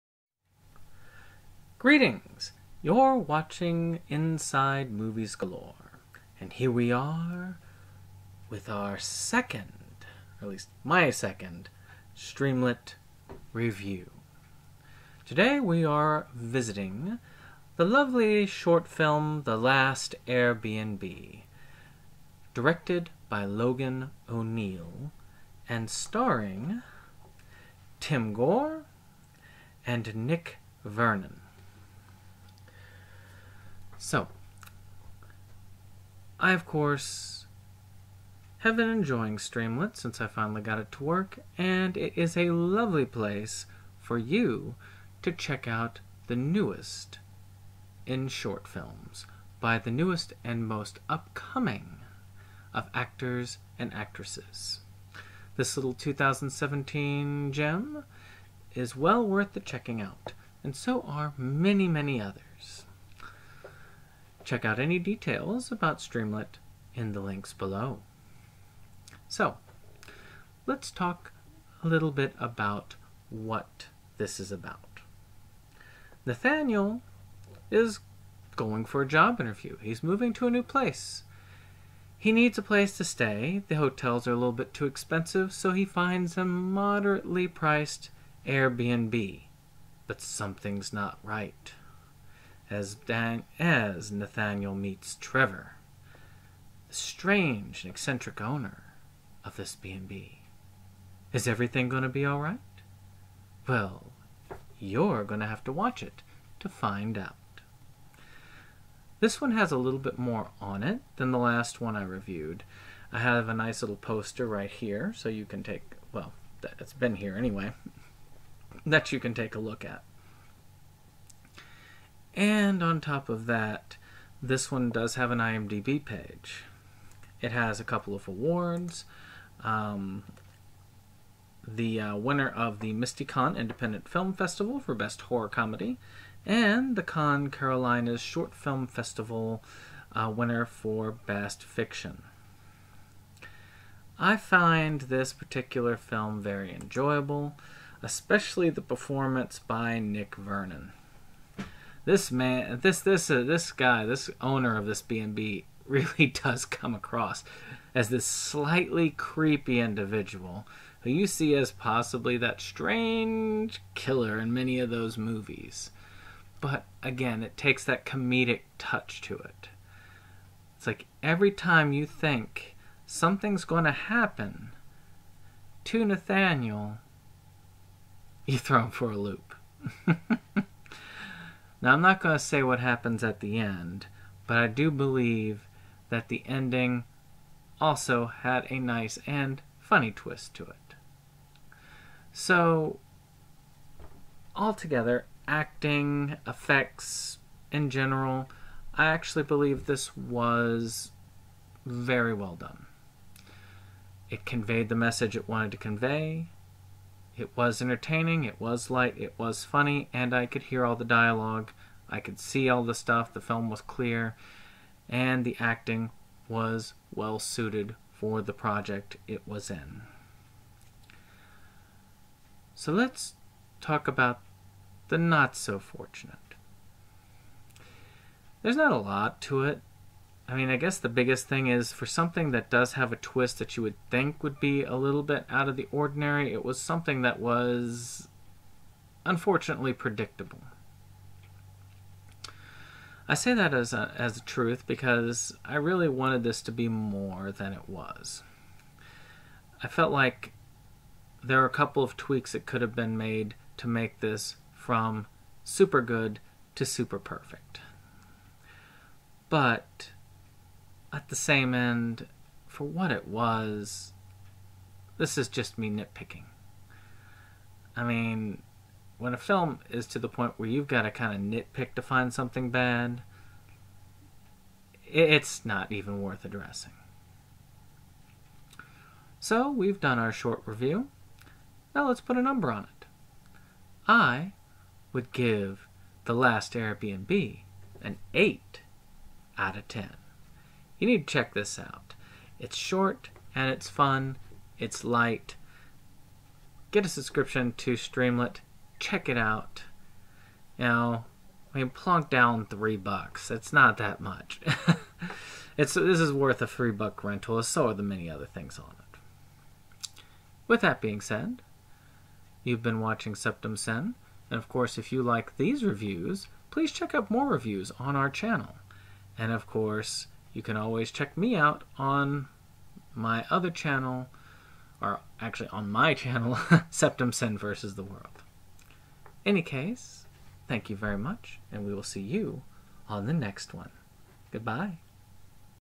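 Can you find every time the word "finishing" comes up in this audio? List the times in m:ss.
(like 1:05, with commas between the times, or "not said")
not said.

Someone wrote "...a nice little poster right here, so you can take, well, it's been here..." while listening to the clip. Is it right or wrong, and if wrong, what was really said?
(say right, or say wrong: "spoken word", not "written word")
right.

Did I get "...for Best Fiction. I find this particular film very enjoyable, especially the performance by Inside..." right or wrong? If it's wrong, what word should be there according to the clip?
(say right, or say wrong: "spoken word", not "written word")
wrong: "Nick", not "Inside".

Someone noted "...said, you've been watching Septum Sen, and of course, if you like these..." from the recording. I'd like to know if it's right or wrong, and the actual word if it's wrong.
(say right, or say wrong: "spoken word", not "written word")
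right.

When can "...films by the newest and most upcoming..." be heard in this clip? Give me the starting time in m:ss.
0:48.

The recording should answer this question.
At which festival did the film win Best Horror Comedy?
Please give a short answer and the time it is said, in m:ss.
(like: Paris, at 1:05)
MystiCon Independent Film Festival, at 2:12.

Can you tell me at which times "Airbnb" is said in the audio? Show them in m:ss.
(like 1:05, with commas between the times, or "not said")
0:20, 1:28, 4:46.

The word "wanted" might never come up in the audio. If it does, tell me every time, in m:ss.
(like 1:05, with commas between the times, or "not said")
3:25, 4:06.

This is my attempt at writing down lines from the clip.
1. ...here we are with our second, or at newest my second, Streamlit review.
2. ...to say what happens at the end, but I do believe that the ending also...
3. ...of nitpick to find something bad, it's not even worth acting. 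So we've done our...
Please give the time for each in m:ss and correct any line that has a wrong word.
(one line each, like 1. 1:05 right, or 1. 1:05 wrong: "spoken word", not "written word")
1. 0:06 wrong: "least", not "newest"
2. 3:02 right
3. 4:31 wrong: "addressing", not "acting".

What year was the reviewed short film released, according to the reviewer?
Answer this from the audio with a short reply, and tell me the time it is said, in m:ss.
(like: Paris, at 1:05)
2017, at 0:55.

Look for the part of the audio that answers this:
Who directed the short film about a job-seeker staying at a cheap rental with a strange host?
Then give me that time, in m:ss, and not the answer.
0:23.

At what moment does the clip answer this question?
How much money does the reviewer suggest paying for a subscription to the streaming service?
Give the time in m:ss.
5:02.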